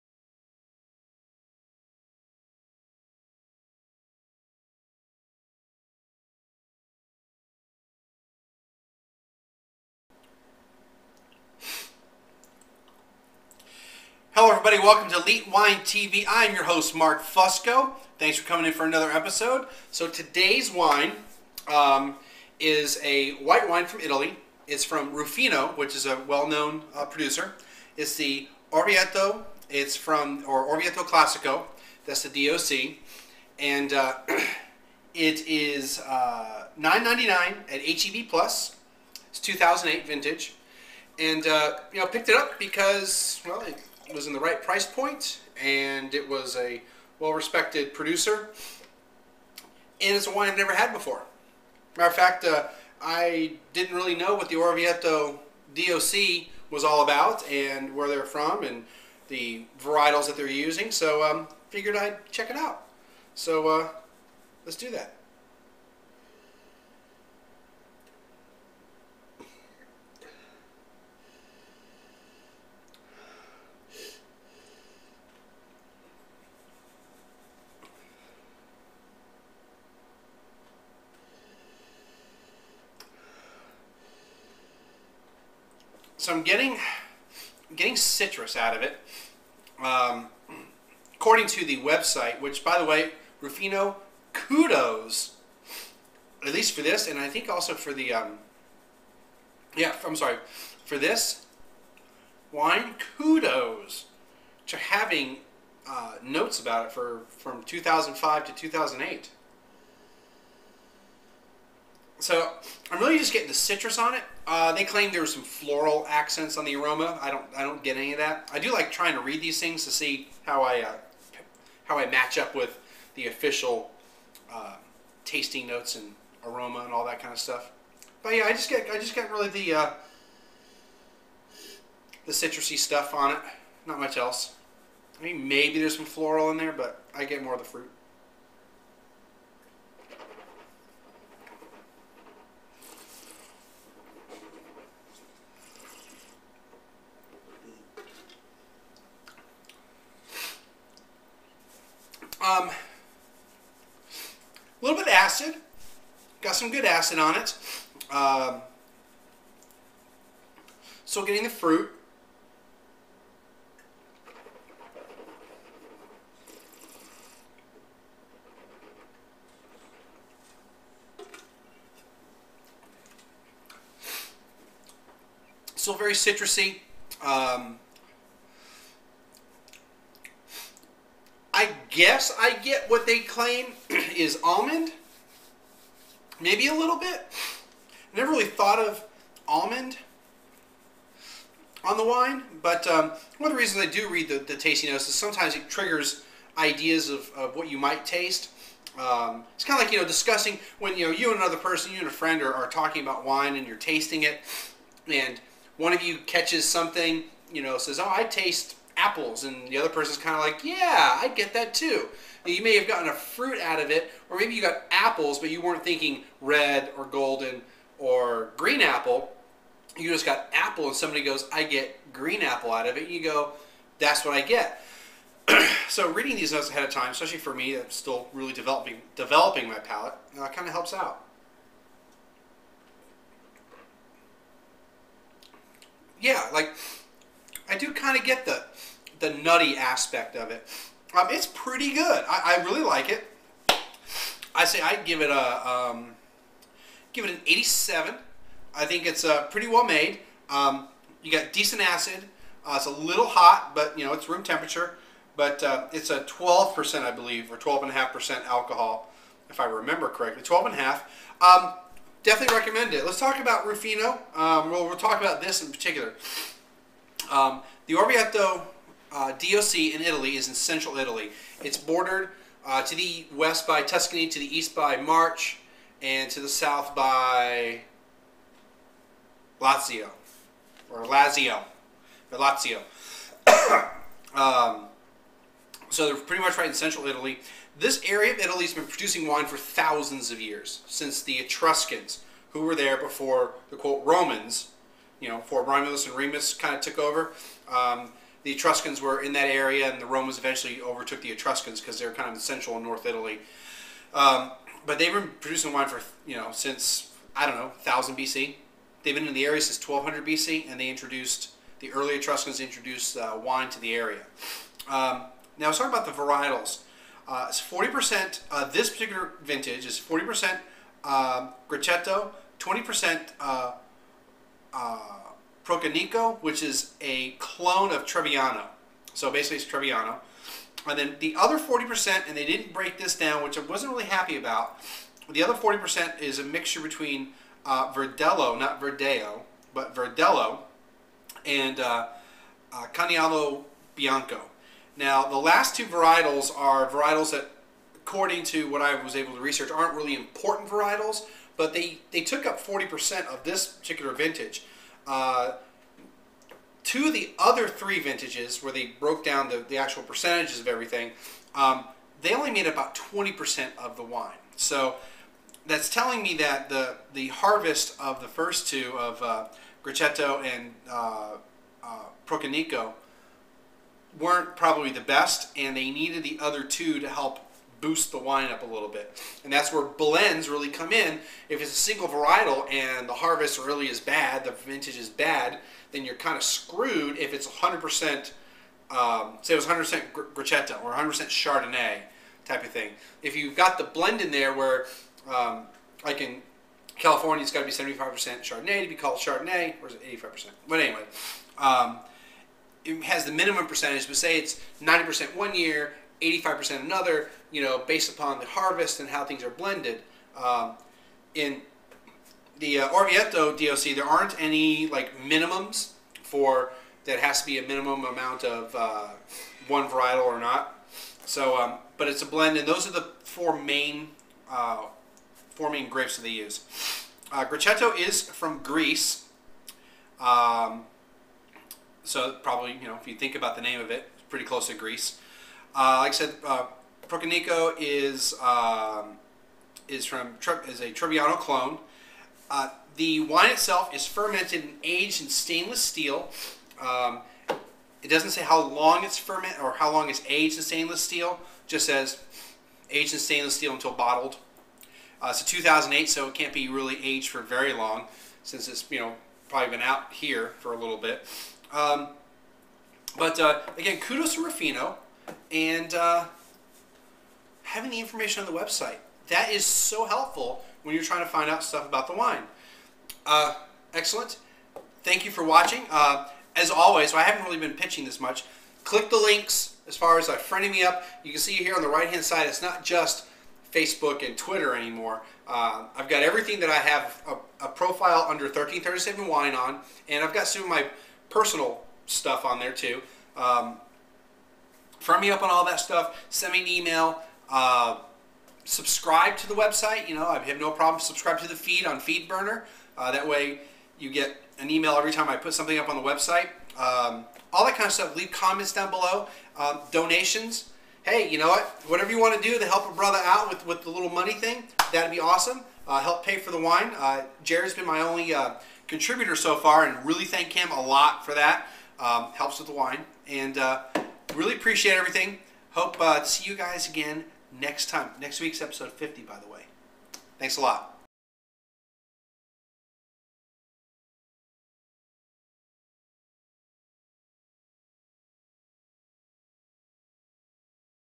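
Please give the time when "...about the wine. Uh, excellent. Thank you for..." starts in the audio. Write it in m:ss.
7:51.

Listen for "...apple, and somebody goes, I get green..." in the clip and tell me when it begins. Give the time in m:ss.
3:40.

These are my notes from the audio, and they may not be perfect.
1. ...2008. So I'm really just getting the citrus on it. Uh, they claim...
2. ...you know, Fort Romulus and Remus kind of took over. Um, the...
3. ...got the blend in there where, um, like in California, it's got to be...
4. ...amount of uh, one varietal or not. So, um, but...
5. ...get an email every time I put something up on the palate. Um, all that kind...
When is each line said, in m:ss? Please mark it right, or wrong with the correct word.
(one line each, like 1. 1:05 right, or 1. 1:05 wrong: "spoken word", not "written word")
1. 1:48 right
2. 4:55 right
3. 6:33 right
4. 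6:58 right
5. 8:24 wrong: "website", not "palate".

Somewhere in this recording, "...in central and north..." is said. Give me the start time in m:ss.
5:02.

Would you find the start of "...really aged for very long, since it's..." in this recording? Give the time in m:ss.
7:36.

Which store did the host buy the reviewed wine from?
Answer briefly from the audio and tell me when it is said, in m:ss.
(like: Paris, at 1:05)
HEB Plus, at 0:37.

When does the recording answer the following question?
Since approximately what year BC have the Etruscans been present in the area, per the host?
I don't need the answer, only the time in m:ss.
5:09.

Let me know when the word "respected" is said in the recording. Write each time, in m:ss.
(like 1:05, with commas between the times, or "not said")
0:47.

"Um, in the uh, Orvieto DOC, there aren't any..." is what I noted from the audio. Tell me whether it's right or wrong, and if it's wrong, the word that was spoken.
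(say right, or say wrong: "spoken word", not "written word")
right.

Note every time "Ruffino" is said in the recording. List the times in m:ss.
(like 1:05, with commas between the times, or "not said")
1:33, 4:23, 7:44.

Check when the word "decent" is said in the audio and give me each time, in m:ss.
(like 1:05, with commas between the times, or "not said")
4:11.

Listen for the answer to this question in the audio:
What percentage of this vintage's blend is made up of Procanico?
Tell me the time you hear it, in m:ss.
5:22.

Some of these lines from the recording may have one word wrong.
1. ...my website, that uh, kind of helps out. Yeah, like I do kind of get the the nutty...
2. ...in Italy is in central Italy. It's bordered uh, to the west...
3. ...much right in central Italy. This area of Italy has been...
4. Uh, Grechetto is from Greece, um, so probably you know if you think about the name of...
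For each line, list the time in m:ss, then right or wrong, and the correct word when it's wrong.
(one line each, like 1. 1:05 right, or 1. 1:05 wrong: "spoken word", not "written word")
1. 3:49 wrong: "palate", not "website"
2. 4:29 right
3. 4:46 right
4. 7:07 right.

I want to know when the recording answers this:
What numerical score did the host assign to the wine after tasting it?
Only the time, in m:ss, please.
4:07.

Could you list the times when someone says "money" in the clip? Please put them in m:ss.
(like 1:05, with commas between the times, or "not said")
8:34.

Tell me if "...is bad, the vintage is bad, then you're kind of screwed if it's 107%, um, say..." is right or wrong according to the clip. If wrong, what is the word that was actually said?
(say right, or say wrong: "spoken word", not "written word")
wrong: "100", not "107".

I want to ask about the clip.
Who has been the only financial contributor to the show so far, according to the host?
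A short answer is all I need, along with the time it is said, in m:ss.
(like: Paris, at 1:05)
Jared, at 8:37.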